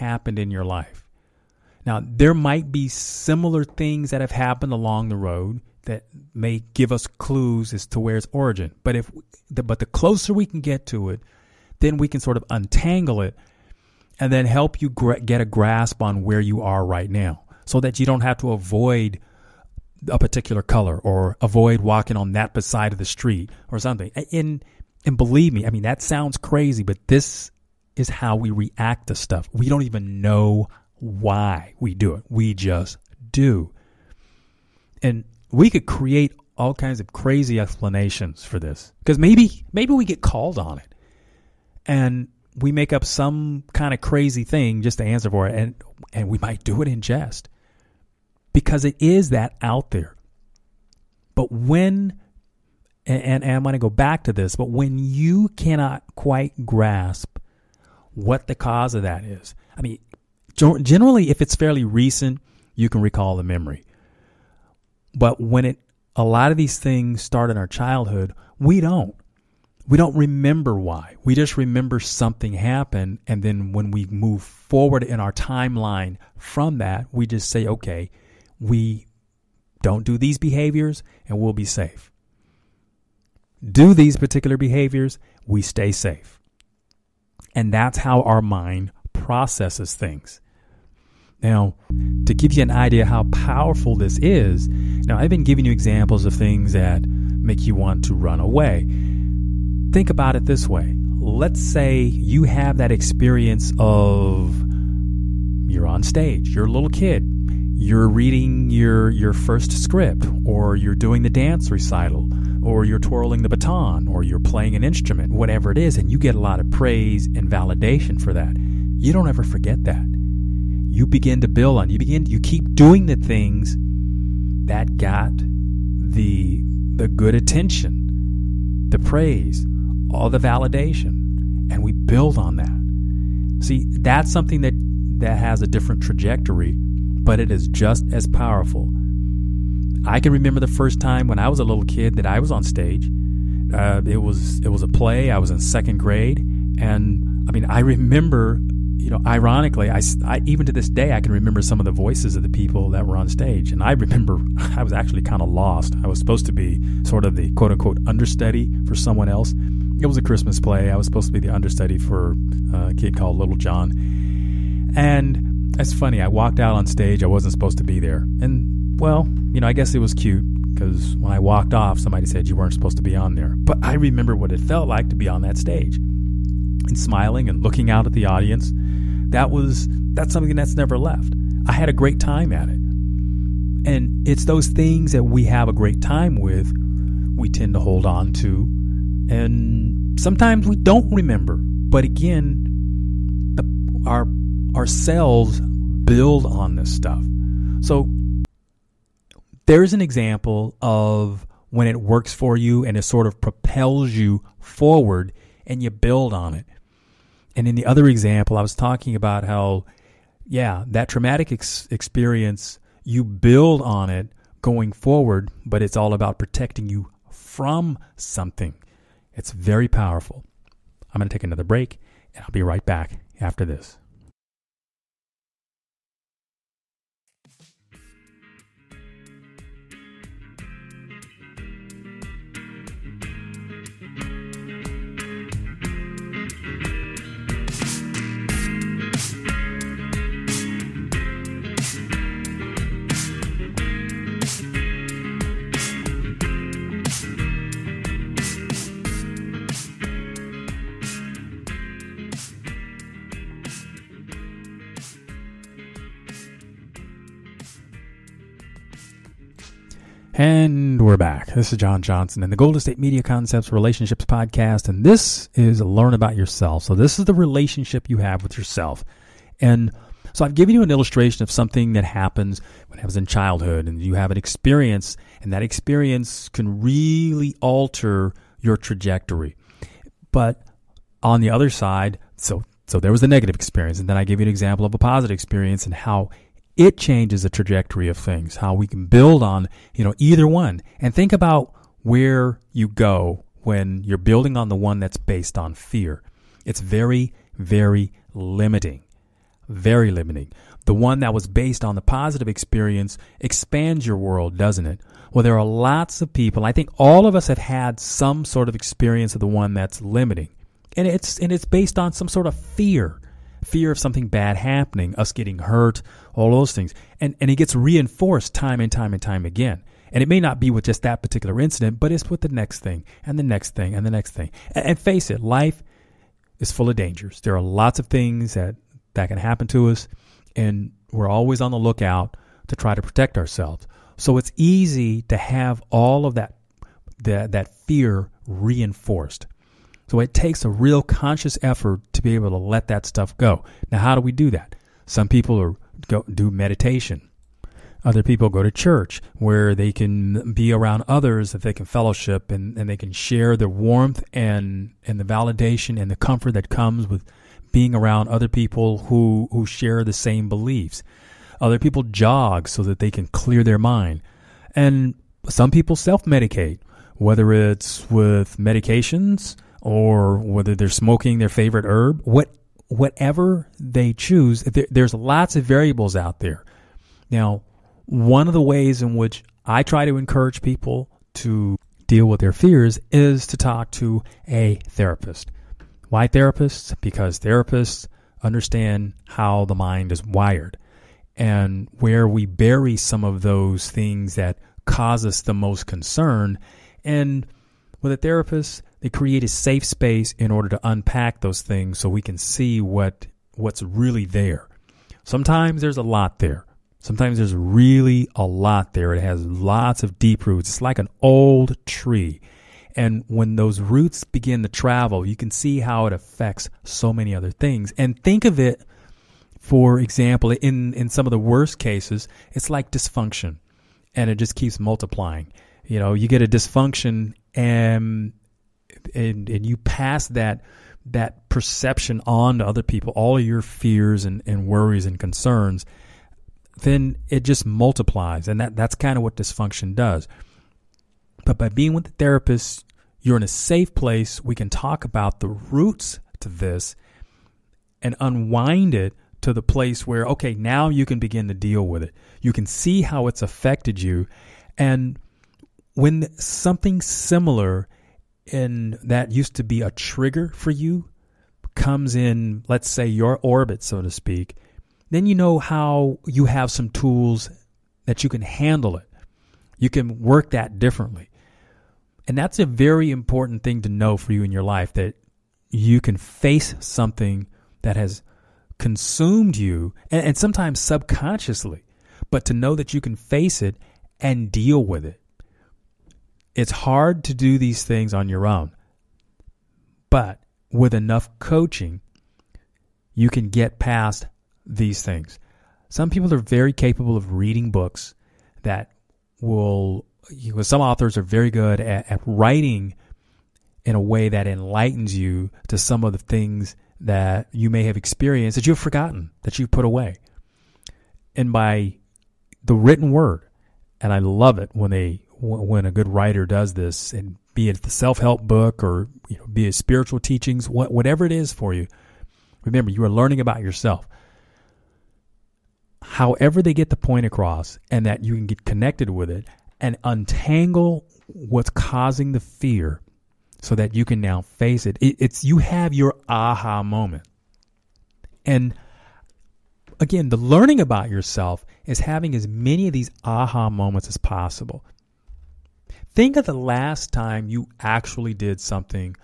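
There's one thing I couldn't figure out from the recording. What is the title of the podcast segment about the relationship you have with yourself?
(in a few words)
Learn About Yourself.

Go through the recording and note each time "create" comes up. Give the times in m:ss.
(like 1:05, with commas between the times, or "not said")
0:35, 6:39.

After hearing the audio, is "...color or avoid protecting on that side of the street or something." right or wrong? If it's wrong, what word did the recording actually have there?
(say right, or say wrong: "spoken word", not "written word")
wrong: "walking", not "protecting".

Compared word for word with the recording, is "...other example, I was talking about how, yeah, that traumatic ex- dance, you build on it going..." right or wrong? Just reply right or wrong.
wrong.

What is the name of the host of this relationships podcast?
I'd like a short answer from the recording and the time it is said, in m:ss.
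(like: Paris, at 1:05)
John Johnson, at 4:21.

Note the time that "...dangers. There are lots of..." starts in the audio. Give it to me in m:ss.
5:26.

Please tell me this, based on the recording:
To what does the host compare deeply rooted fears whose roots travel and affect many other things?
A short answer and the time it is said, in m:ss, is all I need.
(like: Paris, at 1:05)
An old tree, at 6:51.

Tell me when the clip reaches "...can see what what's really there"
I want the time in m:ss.
6:42.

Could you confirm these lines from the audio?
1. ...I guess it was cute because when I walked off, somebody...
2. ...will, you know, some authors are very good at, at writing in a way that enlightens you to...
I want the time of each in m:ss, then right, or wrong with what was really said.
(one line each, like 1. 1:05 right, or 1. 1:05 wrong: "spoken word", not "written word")
1. 2:49 right
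2. 8:19 right.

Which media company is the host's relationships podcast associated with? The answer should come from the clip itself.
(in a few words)
Golden State Media Concepts.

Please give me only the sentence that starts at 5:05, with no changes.
Well, there are lots of people.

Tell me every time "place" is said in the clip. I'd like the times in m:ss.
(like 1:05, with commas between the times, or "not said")
7:23, 7:29.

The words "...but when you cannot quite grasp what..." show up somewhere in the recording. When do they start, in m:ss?
0:54.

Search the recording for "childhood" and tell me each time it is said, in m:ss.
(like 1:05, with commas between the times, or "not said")
1:07, 4:33.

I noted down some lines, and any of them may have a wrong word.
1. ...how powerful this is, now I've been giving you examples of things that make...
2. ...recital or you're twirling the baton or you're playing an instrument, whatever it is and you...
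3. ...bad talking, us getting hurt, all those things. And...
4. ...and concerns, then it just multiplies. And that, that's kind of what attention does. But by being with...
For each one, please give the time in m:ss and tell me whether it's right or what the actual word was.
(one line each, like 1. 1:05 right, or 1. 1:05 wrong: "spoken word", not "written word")
1. 1:33 right
2. 1:51 right
3. 5:14 wrong: "happening", not "talking"
4. 7:15 wrong: "dysfunction", not "attention".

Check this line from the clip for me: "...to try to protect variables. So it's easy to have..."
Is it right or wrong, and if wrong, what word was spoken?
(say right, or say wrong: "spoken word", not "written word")
wrong: "ourselves", not "variables".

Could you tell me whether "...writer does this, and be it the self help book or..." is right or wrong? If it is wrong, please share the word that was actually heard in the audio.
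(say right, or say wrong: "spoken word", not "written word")
right.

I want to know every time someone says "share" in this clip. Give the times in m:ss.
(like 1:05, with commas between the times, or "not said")
5:53, 5:59.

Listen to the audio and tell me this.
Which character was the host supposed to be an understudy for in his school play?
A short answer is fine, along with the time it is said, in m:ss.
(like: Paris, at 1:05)
Little John, at 2:43.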